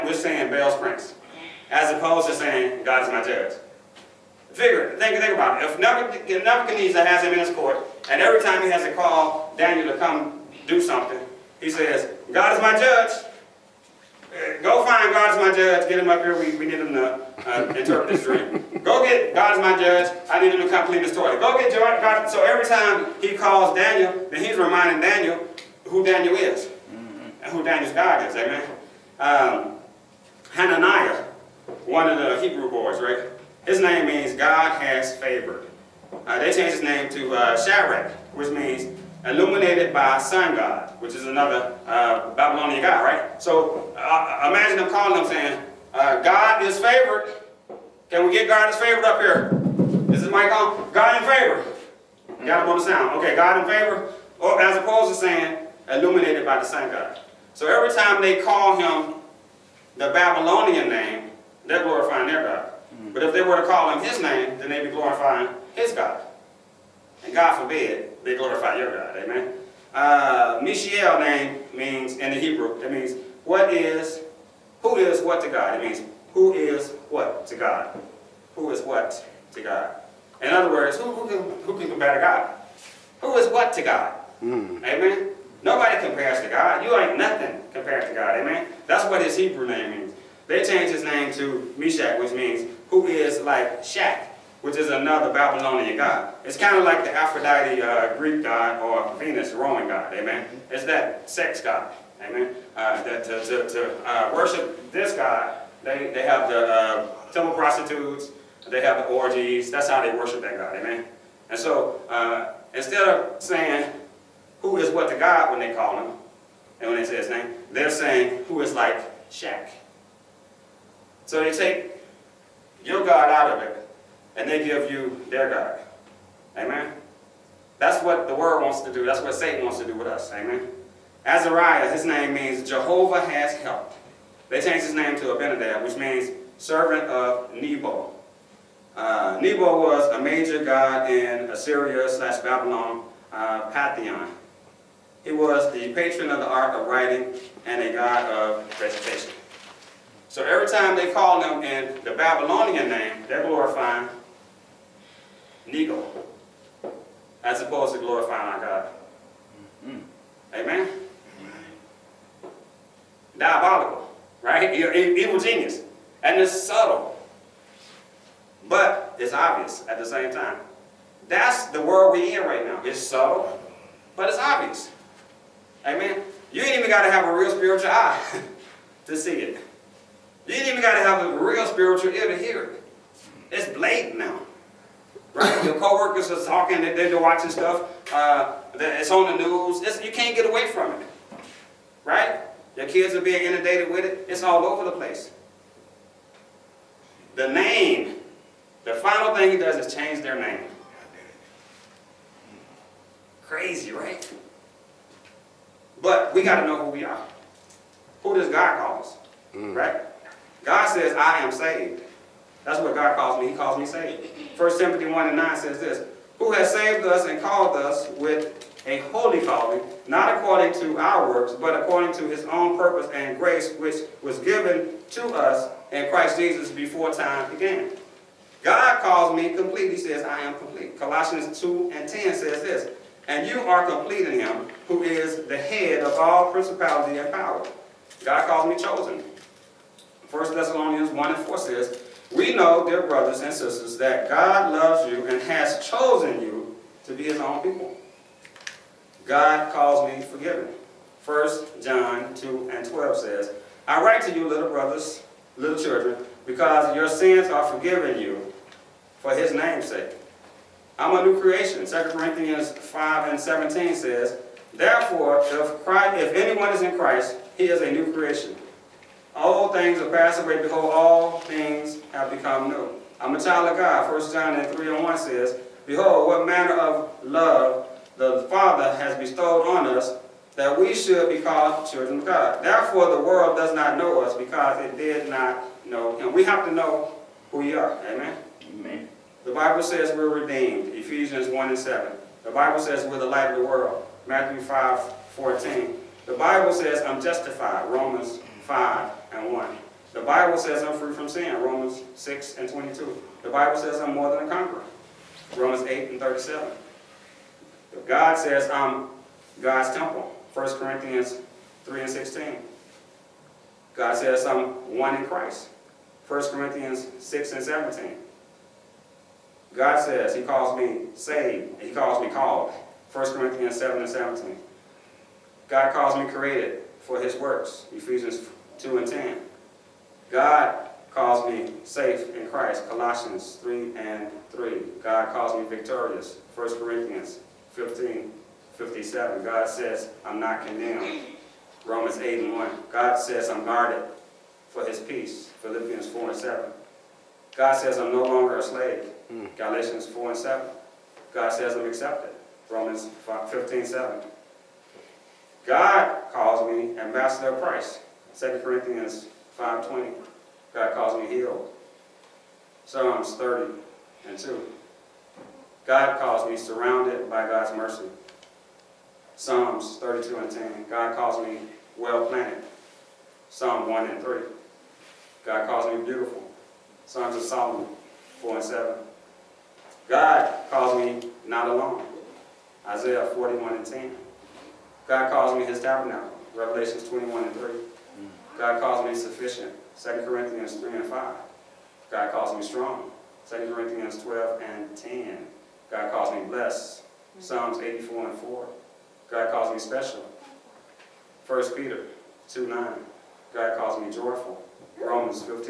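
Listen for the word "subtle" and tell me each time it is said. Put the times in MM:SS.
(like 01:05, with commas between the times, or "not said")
02:46, 02:53.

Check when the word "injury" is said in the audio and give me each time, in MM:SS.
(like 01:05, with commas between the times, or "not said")
not said.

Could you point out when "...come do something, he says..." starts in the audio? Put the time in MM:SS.
00:09.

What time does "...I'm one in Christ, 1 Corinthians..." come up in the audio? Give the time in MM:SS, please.
05:14.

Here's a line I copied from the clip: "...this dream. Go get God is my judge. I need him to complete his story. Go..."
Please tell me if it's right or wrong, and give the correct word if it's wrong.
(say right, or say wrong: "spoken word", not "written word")
right.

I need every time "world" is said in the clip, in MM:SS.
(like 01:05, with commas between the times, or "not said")
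02:08, 02:51, 04:43, 04:53.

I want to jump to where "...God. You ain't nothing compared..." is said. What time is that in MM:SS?
01:26.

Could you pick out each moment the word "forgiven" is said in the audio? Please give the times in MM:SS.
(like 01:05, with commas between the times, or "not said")
04:10, 04:17.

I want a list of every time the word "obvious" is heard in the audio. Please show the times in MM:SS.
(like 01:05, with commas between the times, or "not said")
02:49, 02:54.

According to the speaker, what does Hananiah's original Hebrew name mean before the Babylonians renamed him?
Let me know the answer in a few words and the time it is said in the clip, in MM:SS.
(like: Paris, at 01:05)
God has favored, at 00:34.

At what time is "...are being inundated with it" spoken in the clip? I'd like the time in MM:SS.
03:13.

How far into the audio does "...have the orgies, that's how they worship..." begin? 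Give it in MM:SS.
01:48.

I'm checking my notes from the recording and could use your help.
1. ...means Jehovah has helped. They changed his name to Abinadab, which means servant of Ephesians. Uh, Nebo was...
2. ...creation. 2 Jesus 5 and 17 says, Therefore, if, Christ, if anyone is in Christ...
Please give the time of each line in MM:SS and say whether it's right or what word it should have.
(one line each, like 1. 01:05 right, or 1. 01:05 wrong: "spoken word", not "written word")
1. 02:12 wrong: "Nebo", not "Ephesians"
2. 04:21 wrong: "Corinthians", not "Jesus".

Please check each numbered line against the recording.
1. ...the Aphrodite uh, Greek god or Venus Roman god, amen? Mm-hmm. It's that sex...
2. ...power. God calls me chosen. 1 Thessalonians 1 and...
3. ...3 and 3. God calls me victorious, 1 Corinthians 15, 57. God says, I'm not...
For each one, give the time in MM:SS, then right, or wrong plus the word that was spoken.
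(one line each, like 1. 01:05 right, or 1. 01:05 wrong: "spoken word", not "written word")
1. 01:37 right
2. 03:57 right
3. 05:33 right.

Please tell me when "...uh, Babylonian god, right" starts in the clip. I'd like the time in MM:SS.
00:41.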